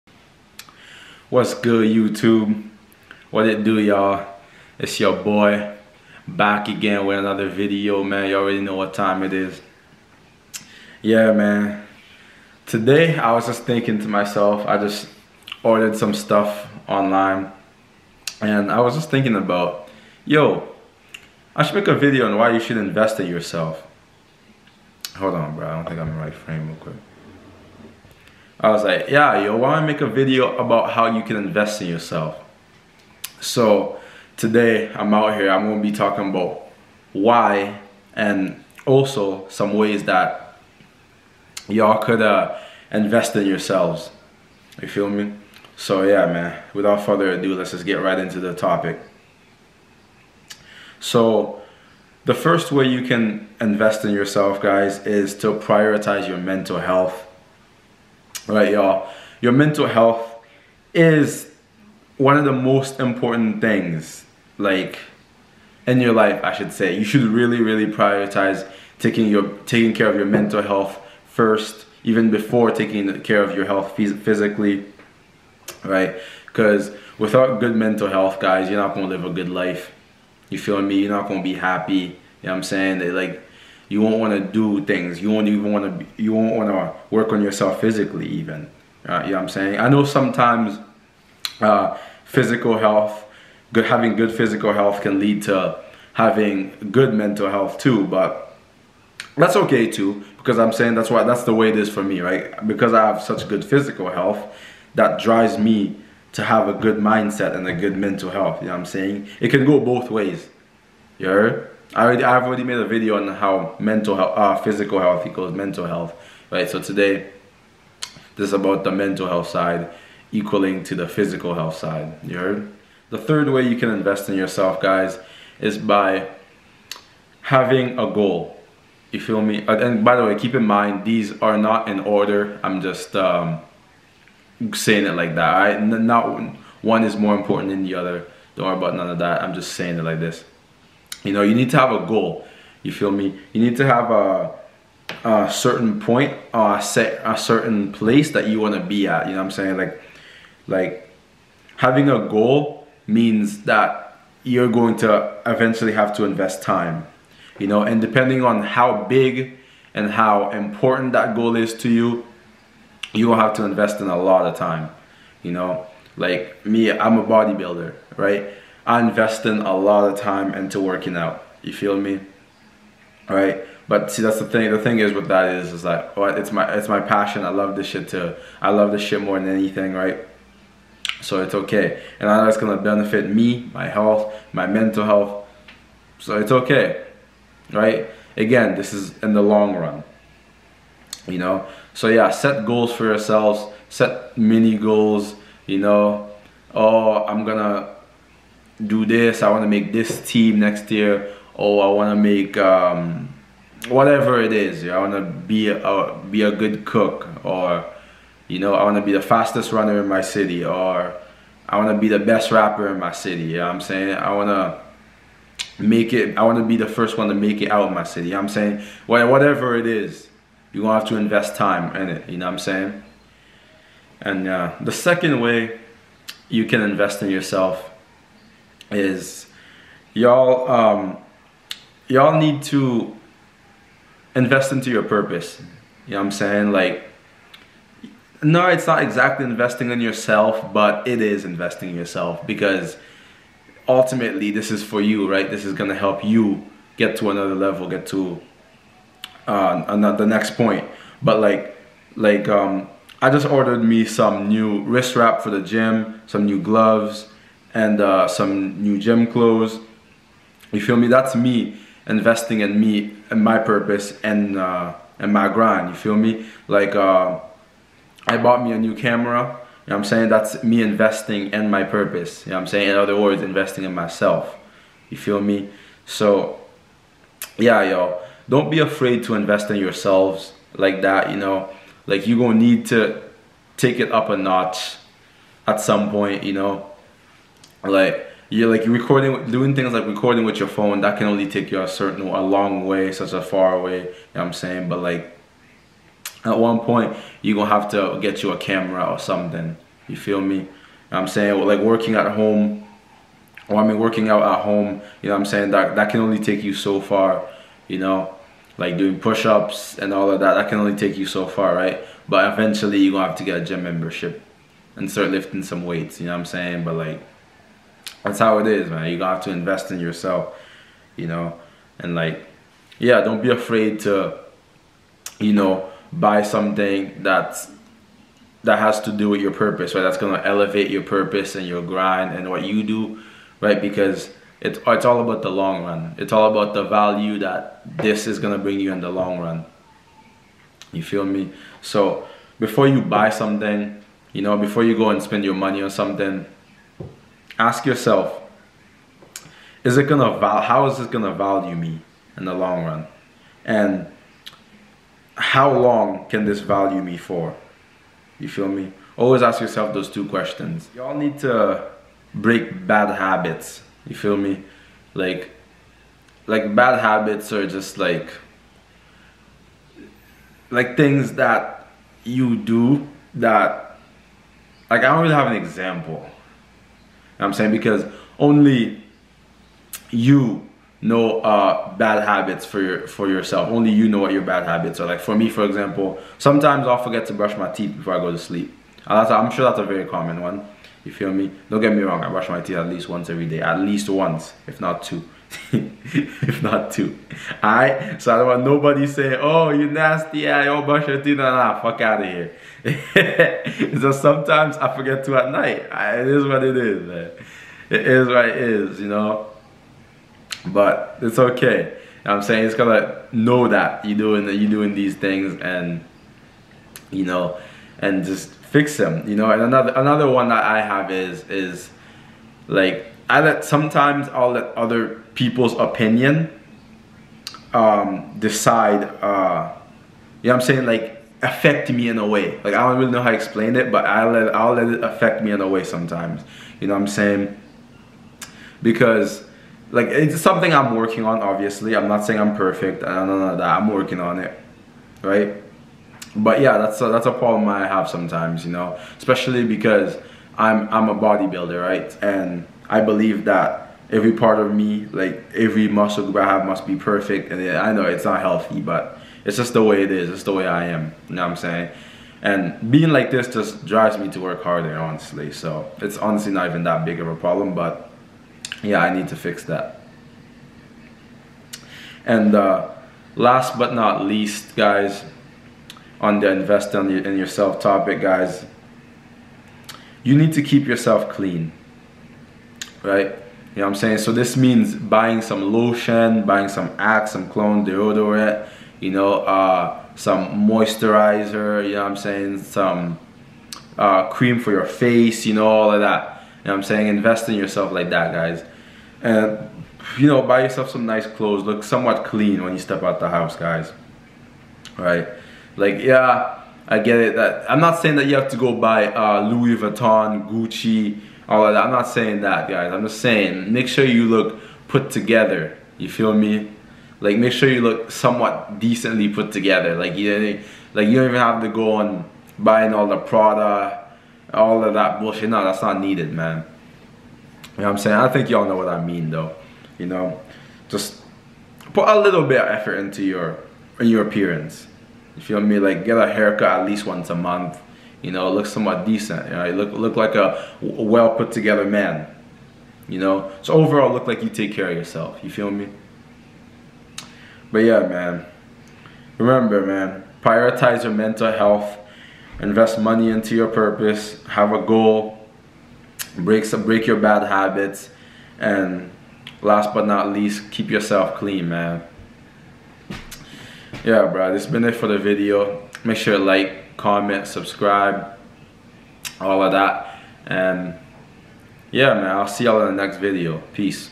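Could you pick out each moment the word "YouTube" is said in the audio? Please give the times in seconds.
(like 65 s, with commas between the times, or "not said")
1 s.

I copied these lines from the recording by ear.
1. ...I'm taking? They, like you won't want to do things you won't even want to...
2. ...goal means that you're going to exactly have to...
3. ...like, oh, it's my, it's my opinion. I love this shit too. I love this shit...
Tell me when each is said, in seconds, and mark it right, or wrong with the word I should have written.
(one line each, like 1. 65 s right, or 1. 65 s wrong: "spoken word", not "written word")
1. 82 s wrong: "saying", not "taking"
2. 152 s wrong: "eventually", not "exactly"
3. 175 s wrong: "passion", not "opinion".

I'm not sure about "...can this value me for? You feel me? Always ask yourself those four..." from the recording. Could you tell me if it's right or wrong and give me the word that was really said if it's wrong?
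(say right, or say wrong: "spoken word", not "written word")
wrong: "two", not "four".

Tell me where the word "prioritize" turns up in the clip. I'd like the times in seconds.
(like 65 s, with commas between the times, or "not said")
55 s, 67 s, 550 s.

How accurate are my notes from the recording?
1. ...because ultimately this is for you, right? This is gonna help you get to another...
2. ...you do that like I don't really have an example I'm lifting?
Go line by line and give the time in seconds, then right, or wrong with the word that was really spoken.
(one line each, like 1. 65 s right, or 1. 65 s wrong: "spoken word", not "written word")
1. 242 s right
2. 372 s wrong: "saying", not "lifting".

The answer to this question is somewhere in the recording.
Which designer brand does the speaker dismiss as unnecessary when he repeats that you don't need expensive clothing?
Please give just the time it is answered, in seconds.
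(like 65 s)
523 s.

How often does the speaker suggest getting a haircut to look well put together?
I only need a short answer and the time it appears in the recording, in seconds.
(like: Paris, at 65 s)
Once a month, at 537 s.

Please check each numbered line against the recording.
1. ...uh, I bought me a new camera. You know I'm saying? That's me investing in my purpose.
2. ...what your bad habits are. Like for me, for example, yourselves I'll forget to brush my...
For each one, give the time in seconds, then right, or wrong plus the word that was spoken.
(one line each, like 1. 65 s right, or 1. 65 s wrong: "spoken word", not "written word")
1. 266 s right
2. 384 s wrong: "sometimes", not "yourselves".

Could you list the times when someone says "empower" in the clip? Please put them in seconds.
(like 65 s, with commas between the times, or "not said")
not said.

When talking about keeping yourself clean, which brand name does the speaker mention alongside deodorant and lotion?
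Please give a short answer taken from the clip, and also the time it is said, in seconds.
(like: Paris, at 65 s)
Axe, at 486 s.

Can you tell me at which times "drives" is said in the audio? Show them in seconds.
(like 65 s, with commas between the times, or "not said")
105 s, 463 s.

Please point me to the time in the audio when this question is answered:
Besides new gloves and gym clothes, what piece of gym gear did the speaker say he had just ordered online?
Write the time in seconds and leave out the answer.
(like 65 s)
254 s.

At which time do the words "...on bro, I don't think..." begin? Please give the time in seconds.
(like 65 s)
25 s.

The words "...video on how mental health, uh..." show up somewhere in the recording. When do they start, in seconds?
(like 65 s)
112 s.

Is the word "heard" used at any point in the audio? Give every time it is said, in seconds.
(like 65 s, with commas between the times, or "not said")
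111 s, 122 s.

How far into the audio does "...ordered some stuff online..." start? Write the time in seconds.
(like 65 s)
15 s.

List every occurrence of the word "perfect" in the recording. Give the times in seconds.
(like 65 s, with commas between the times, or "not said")
442 s, 456 s.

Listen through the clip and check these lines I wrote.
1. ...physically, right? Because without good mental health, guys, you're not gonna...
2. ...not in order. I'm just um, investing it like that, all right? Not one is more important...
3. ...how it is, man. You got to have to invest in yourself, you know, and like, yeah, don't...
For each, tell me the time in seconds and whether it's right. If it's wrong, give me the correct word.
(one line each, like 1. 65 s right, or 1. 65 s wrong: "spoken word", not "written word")
1. 73 s right
2. 131 s wrong: "saying", not "investing"
3. 318 s right.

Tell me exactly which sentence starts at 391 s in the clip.
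Don't get me wrong, I brush my teeth at least once every day.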